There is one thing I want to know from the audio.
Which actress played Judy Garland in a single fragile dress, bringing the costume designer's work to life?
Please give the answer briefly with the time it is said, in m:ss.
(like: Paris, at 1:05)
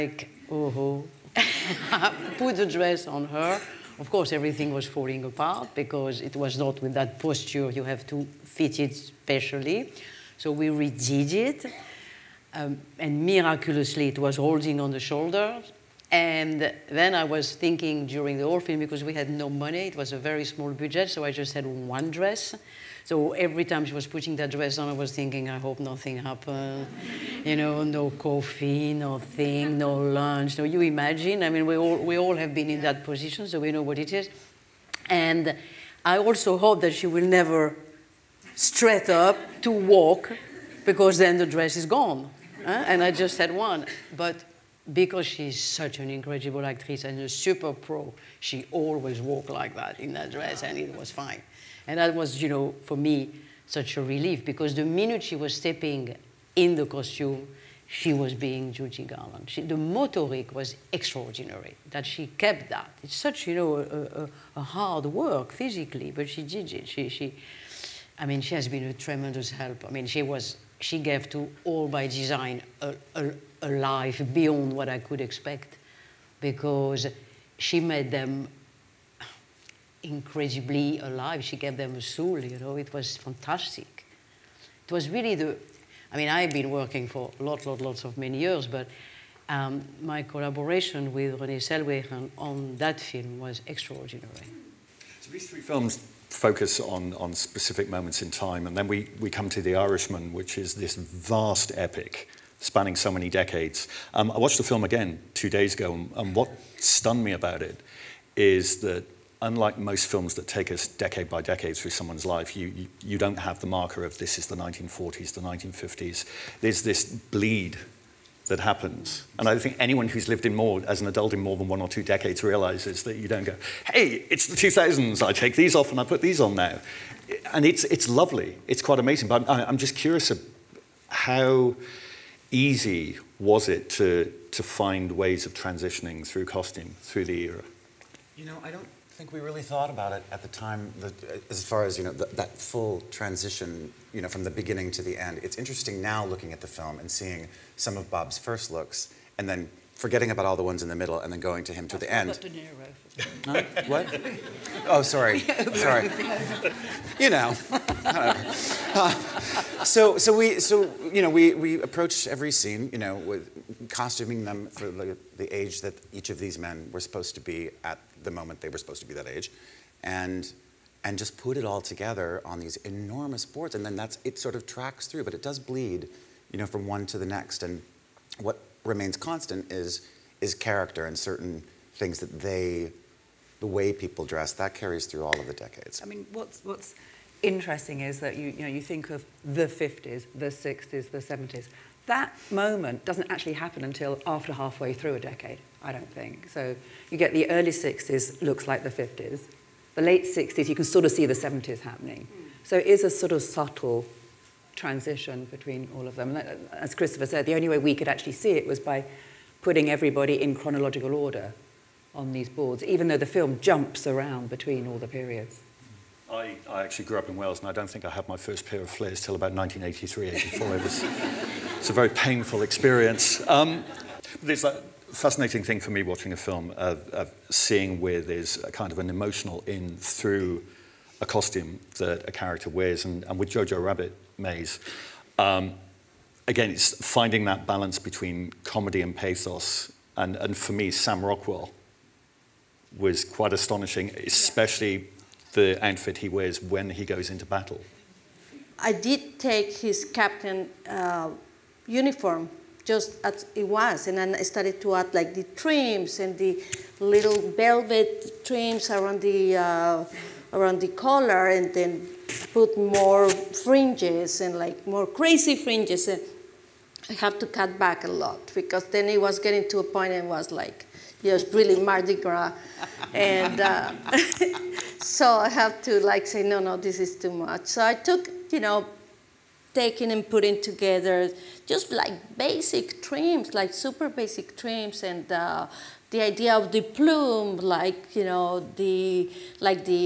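Renee Zellweger, at 1:31.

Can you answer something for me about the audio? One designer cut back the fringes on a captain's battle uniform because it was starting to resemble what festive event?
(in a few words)
Mardi Gras.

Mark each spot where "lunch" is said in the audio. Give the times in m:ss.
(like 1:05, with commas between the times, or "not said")
0:29.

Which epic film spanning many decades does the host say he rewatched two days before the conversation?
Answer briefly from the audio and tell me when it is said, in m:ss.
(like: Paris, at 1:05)
The Irishman, at 1:39.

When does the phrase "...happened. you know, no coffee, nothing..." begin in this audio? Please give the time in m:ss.
0:26.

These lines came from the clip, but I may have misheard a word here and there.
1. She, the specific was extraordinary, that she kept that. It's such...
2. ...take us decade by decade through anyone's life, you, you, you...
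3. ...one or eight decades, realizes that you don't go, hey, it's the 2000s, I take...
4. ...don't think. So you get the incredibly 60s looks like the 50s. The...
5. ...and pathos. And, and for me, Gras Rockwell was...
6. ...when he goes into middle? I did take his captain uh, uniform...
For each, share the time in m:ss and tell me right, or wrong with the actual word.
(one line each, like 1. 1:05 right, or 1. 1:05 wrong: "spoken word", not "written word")
1. 0:59 wrong: "motoric", not "specific"
2. 1:50 wrong: "someone", not "anyone"
3. 2:01 wrong: "two", not "eight"
4. 3:15 wrong: "early", not "incredibly"
5. 3:59 wrong: "Sam", not "Gras"
6. 4:06 wrong: "battle", not "middle".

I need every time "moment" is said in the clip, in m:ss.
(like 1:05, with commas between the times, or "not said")
1:37, 2:48, 3:12.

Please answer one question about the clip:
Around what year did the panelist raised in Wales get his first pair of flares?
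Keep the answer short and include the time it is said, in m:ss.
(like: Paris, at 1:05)
1983, at 3:39.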